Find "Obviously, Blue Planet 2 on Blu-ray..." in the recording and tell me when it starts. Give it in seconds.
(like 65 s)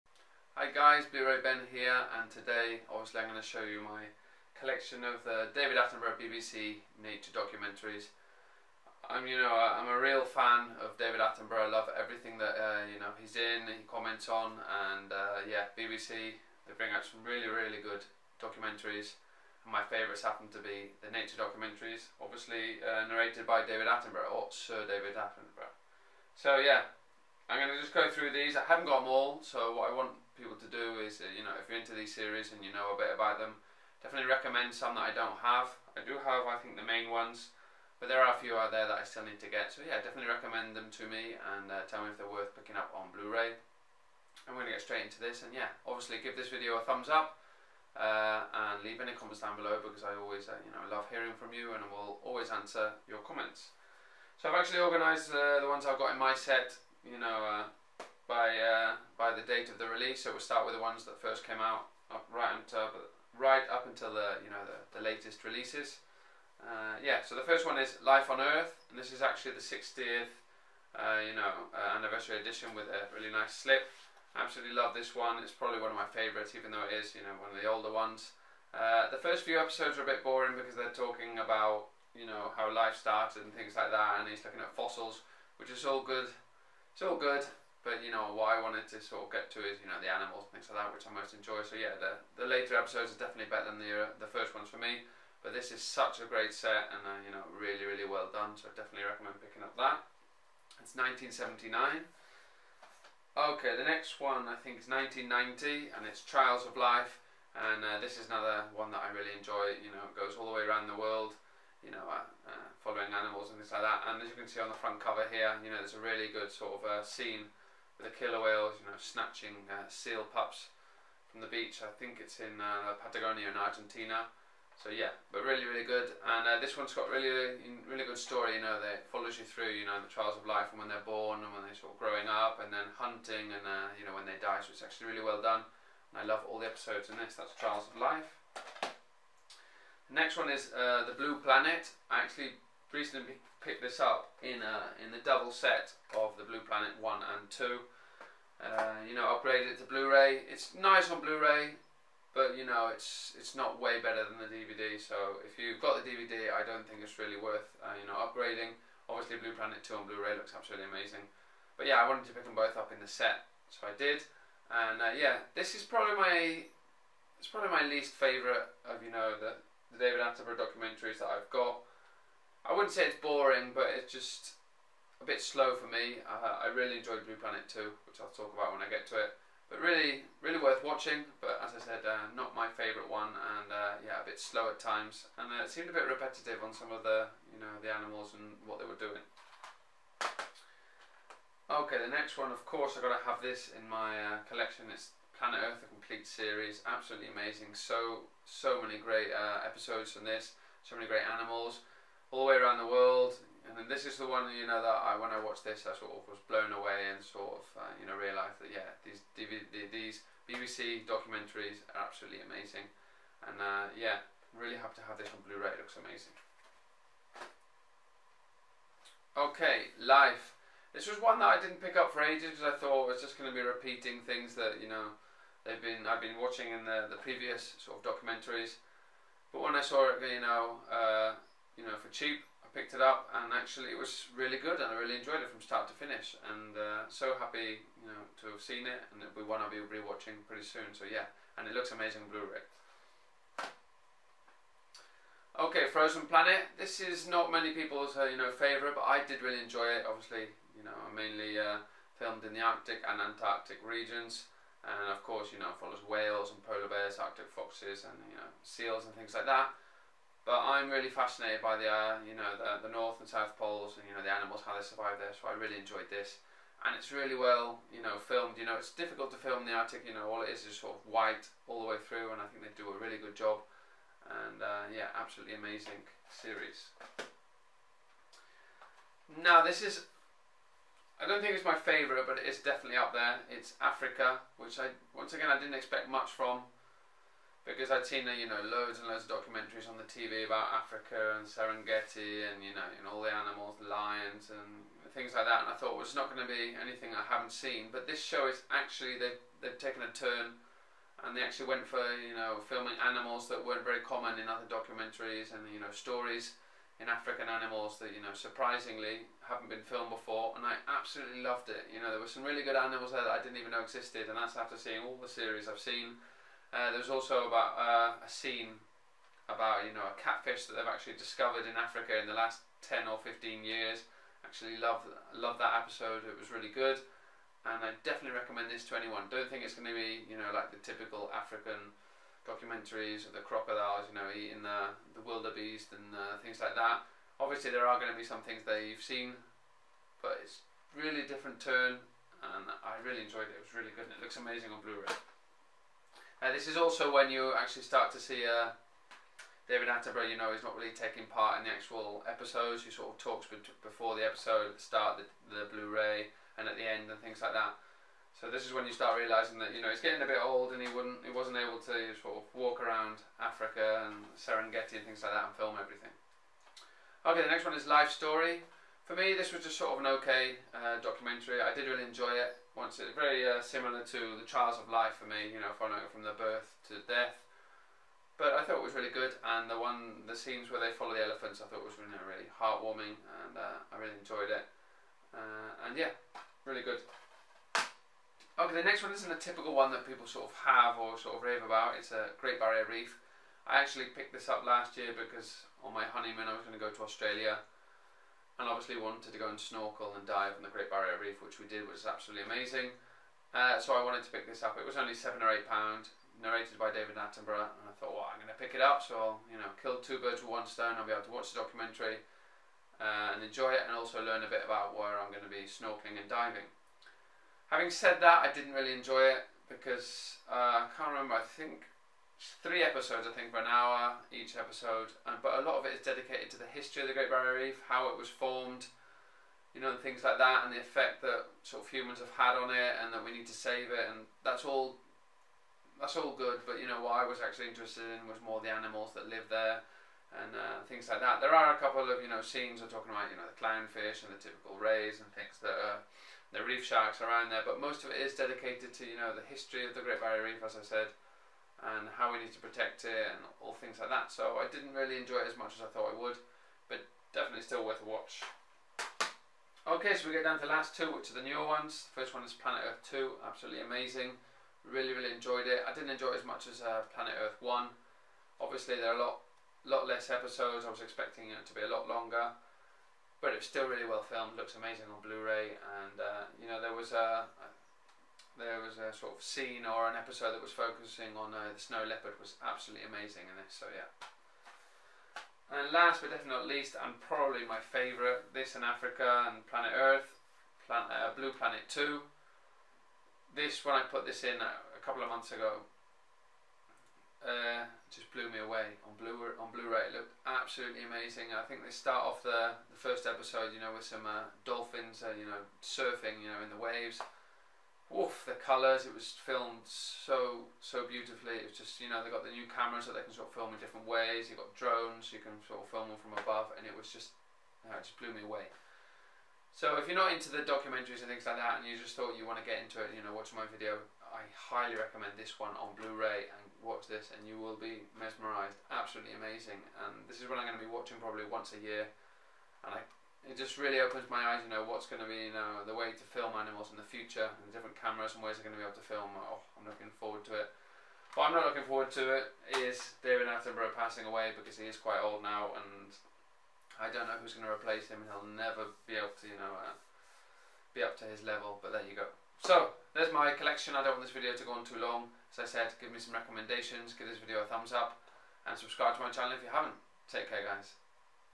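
159 s.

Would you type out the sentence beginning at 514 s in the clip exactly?
You've got drones, you can sort of film them from above, and it was just, no, uh, it just blew me away.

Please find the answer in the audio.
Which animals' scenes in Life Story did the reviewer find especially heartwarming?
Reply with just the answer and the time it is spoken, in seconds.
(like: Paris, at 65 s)
elephants, at 381 s.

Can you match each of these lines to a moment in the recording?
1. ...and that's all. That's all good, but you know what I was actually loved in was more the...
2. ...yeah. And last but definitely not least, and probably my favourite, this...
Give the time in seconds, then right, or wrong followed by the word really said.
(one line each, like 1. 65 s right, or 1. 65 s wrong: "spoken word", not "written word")
1. 434 s wrong: "interested", not "loved"
2. 483 s right.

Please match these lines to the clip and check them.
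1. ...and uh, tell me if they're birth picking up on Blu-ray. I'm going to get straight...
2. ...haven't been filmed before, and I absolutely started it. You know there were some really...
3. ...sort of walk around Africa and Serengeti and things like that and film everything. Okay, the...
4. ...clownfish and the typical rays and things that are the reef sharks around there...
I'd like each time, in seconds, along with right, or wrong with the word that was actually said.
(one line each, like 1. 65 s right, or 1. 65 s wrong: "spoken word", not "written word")
1. 41 s wrong: "worth", not "birth"
2. 309 s wrong: "loved", not "started"
3. 362 s right
4. 443 s right.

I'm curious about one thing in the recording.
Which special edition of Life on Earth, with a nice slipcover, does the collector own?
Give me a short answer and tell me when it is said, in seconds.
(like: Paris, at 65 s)
60th anniversary edition, at 69 s.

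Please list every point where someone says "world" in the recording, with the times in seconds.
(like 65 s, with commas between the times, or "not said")
110 s, 202 s.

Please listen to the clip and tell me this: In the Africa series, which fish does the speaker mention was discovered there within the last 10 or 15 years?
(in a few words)
catfish.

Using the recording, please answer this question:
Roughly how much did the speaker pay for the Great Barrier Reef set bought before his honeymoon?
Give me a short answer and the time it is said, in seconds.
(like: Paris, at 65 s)
7 or 8 pounds, at 405 s.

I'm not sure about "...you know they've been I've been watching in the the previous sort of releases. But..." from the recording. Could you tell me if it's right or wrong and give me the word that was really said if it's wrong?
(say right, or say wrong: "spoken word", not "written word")
wrong: "documentaries", not "releases".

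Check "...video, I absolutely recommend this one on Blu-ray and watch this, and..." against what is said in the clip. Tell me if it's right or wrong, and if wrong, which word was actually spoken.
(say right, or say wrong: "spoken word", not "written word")
wrong: "highly", not "absolutely".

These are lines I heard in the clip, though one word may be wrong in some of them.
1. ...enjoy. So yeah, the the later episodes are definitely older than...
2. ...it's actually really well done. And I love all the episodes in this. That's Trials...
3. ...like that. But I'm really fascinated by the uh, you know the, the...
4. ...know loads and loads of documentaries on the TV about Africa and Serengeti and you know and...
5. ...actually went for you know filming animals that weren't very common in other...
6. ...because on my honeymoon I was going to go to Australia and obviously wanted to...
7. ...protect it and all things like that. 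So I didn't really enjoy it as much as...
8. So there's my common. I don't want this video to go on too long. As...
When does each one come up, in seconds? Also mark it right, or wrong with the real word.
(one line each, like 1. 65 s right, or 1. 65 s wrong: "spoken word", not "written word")
1. 91 s wrong: "better", not "older"
2. 134 s right
3. 259 s right
4. 288 s right
5. 301 s right
6. 395 s right
7. 452 s right
8. 552 s wrong: "collection", not "common".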